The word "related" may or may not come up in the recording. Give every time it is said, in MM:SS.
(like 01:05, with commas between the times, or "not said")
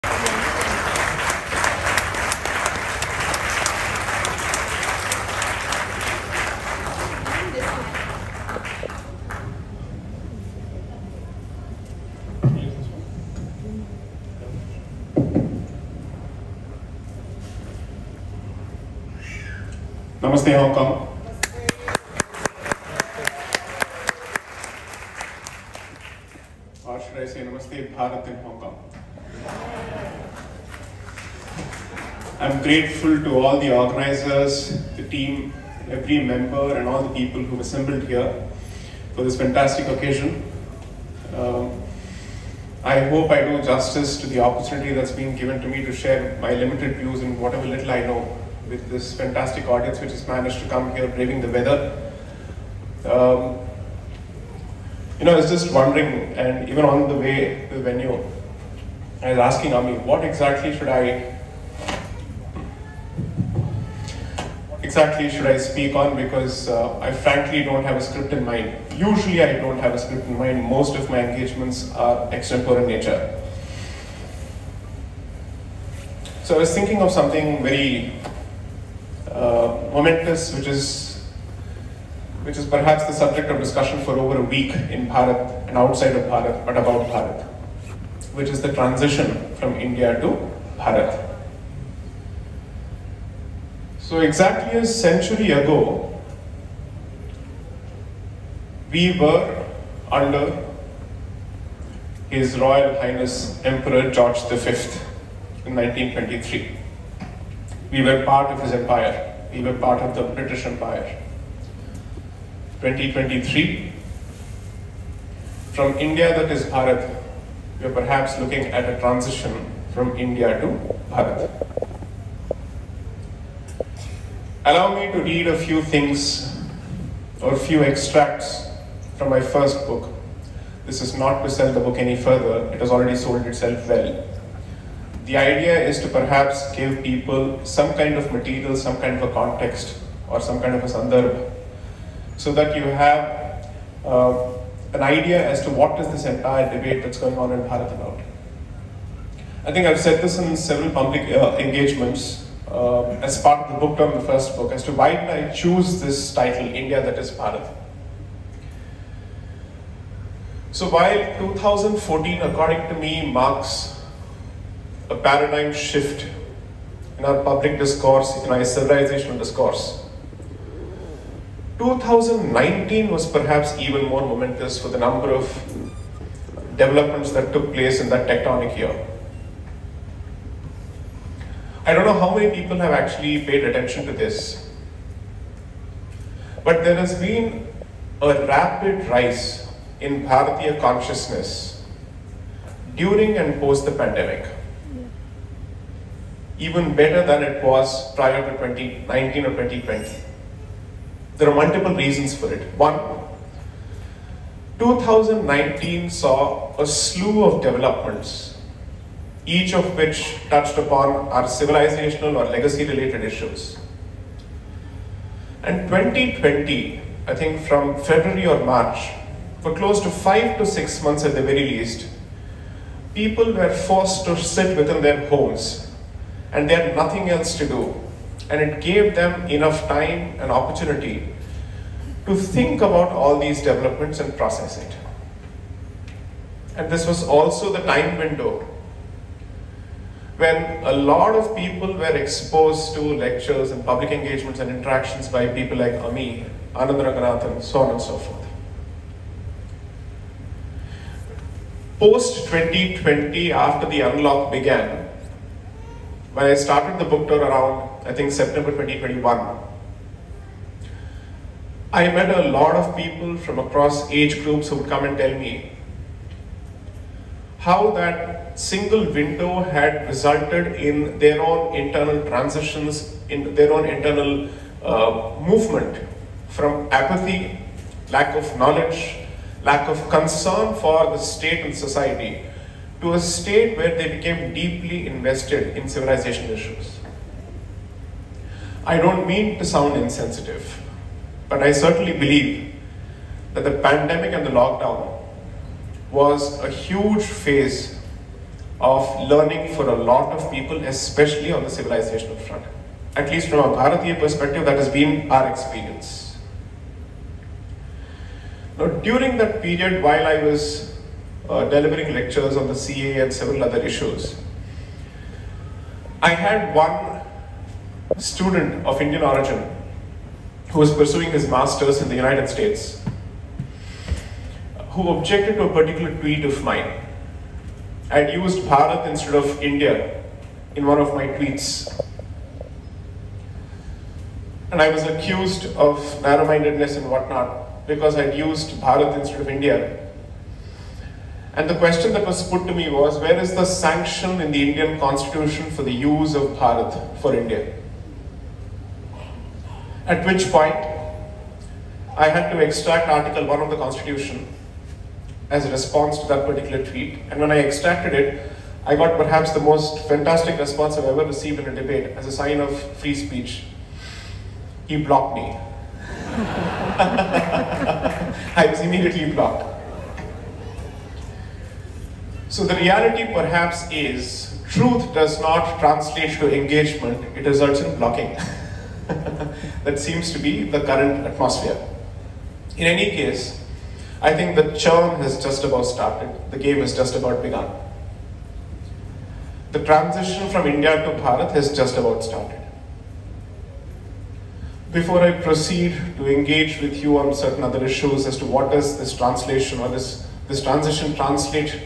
03:32.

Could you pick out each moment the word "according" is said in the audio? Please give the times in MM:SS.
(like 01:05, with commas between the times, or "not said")
02:42.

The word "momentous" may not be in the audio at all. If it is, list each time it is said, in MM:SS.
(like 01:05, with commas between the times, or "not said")
01:19, 02:54.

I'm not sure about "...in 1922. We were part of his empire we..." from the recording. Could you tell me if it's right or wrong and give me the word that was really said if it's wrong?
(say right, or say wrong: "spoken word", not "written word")
wrong: "1923", not "1922".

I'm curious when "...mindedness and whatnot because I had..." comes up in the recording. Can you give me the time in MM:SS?
05:36.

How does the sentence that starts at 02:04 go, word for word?
Allow me to read a few things or a few extracts from my first book.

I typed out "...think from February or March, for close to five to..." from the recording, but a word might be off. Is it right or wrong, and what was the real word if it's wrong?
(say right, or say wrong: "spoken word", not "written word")
right.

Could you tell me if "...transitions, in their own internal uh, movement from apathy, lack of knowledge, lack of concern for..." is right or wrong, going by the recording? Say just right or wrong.
right.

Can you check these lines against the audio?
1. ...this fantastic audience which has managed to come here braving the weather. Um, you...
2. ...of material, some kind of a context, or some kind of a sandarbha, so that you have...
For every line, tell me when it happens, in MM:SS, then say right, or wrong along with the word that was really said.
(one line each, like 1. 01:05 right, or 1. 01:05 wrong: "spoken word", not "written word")
1. 00:48 right
2. 02:18 right.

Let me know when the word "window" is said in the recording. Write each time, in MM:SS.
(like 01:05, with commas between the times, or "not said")
03:58, 04:29.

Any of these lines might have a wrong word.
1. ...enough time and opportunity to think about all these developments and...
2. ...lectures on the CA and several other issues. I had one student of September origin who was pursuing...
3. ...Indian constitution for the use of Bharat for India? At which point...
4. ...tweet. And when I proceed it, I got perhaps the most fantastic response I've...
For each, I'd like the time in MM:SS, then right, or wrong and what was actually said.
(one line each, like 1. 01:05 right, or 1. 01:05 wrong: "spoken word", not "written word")
1. 03:49 right
2. 05:12 wrong: "Indian", not "September"
3. 05:44 right
4. 05:56 wrong: "extracted", not "proceed".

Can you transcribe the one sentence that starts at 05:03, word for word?
At least from a Bharatiya perspective, that has been our experience.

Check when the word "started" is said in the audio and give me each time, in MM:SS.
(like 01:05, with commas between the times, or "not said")
04:16, 06:25, 06:32.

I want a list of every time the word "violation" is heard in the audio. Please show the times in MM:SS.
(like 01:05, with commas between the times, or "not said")
not said.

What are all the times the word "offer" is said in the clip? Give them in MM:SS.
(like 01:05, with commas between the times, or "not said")
not said.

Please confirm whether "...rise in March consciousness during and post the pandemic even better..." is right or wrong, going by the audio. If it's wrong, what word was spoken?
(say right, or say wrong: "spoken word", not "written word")
wrong: "Bharatiya", not "March".